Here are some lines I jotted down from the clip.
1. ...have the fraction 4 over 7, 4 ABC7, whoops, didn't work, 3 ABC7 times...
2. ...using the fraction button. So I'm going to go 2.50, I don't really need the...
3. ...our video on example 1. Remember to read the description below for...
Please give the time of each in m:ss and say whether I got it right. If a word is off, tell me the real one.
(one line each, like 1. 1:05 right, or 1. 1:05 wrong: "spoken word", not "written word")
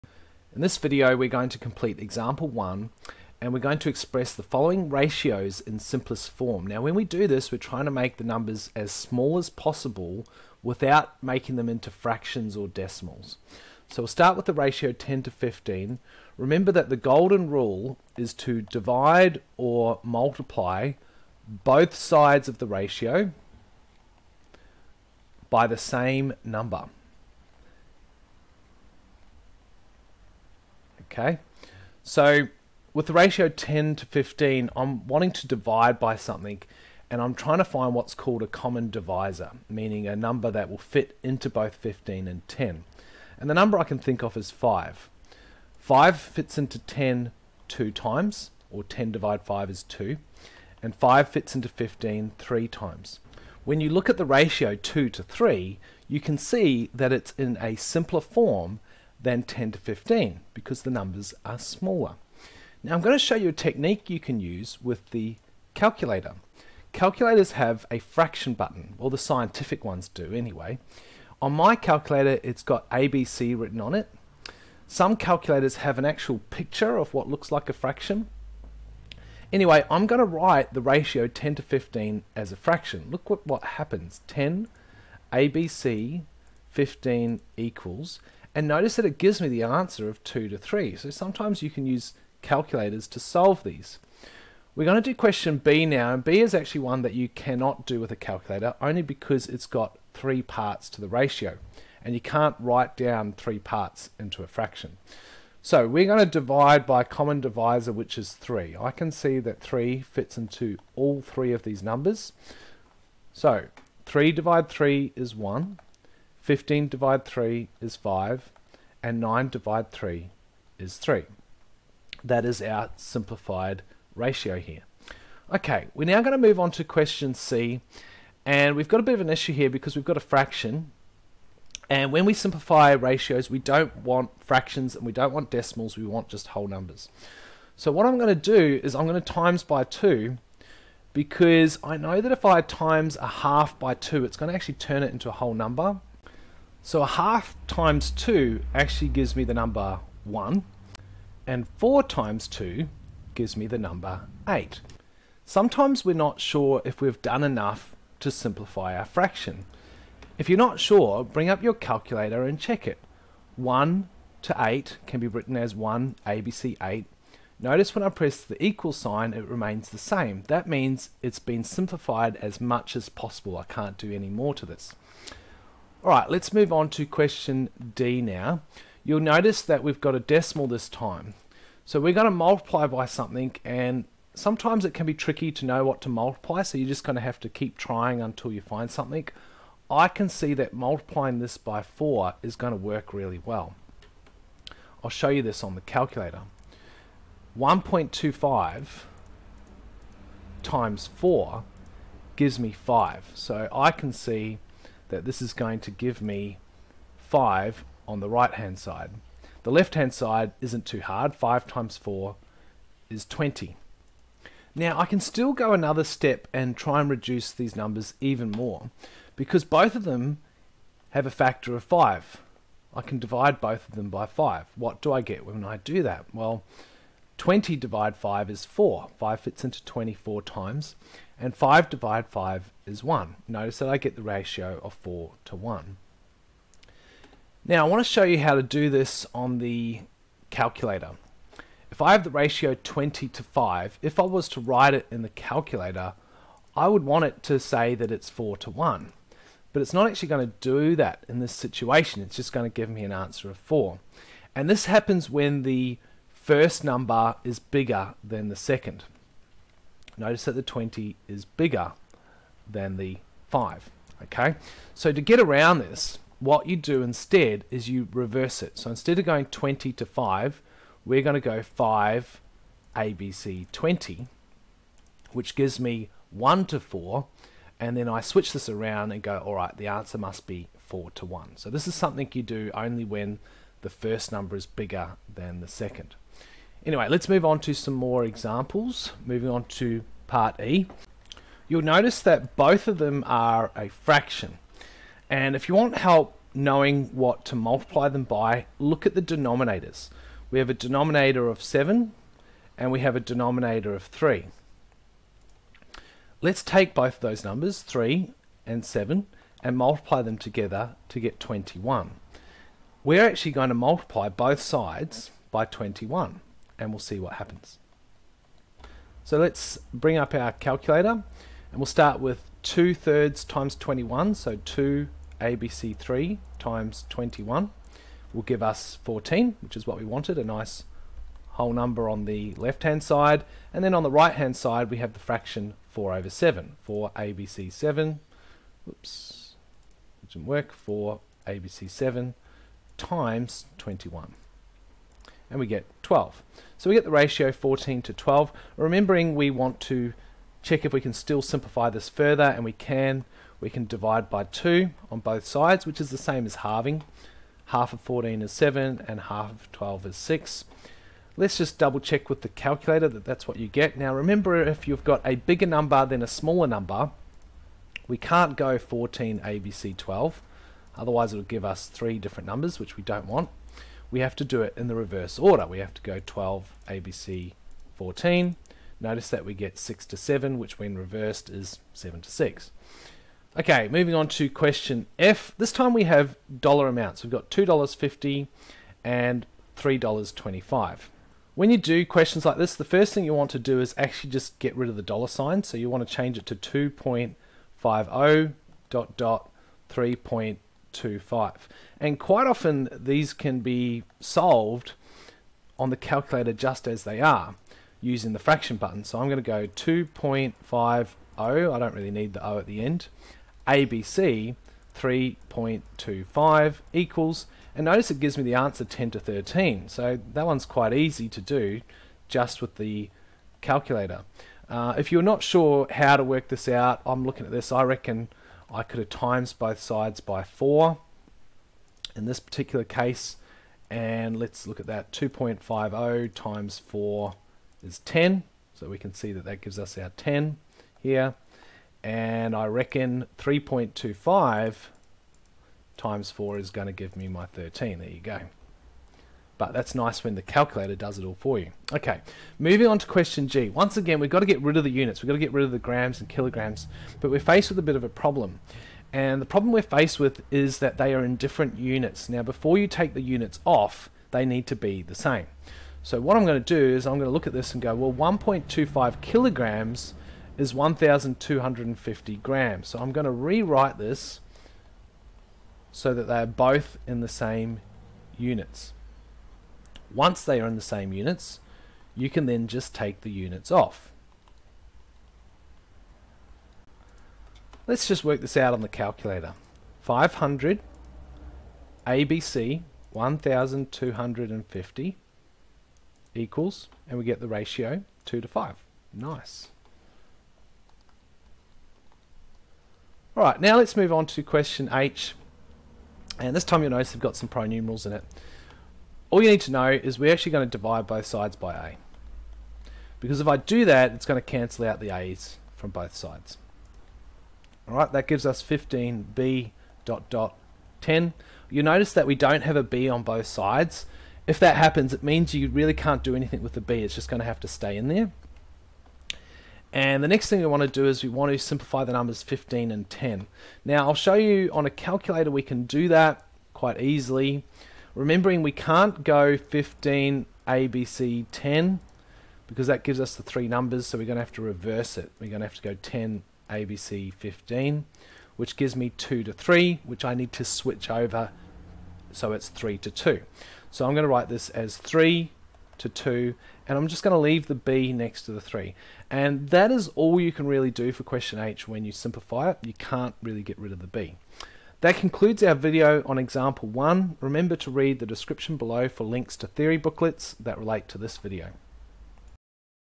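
1. 5:34 wrong: "4", not "3"
2. 6:48 right
3. 9:25 right.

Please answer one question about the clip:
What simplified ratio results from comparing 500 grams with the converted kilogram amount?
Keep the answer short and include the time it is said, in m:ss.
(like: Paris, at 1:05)
2 to 5, at 8:18.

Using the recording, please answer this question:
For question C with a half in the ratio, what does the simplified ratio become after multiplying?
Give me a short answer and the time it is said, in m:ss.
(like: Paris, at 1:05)
1 to 8, at 2:43.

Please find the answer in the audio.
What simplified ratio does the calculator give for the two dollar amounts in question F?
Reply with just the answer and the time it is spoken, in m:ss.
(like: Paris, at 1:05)
10 to 13, at 6:58.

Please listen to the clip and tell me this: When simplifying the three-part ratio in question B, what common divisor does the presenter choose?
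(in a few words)
3.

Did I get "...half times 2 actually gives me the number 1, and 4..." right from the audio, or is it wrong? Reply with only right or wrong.
right.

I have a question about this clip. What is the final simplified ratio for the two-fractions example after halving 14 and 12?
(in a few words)
7 to 6.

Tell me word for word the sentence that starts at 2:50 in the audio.
That means it's been simplified as much as possible.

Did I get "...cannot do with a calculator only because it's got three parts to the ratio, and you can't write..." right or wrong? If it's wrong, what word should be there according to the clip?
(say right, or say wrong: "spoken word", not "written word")
right.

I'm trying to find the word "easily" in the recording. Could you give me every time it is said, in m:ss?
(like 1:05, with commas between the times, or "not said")
8:56.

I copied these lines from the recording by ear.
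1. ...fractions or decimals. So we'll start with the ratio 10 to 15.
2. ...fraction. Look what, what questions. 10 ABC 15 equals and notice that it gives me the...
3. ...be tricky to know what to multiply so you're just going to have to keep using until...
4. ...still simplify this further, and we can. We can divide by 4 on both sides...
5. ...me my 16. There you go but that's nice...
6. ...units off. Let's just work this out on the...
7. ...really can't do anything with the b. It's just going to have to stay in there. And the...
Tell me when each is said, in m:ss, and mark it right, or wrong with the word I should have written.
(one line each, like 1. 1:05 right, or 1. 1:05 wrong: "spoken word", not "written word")
1. 0:11 right
2. 1:22 wrong: "happens", not "questions"
3. 3:05 wrong: "trying", not "using"
4. 5:51 wrong: "2", not "4"
5. 7:27 wrong: "13", not "16"
6. 8:03 right
7. 8:45 right.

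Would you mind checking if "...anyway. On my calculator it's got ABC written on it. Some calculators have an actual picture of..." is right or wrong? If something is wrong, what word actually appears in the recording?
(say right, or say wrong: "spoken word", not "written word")
right.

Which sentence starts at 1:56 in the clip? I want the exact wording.
15 divide 3 is 5, and 9 divide 3 is 3.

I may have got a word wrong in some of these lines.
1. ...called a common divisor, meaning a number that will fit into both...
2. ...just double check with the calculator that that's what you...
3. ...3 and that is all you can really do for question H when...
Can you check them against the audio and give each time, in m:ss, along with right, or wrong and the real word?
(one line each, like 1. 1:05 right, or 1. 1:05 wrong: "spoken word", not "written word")
1. 0:38 right
2. 6:01 right
3. 9:18 right.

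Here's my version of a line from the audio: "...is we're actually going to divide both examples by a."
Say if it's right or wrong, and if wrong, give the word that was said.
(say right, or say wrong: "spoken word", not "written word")
wrong: "sides", not "examples".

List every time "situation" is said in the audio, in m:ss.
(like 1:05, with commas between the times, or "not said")
4:11.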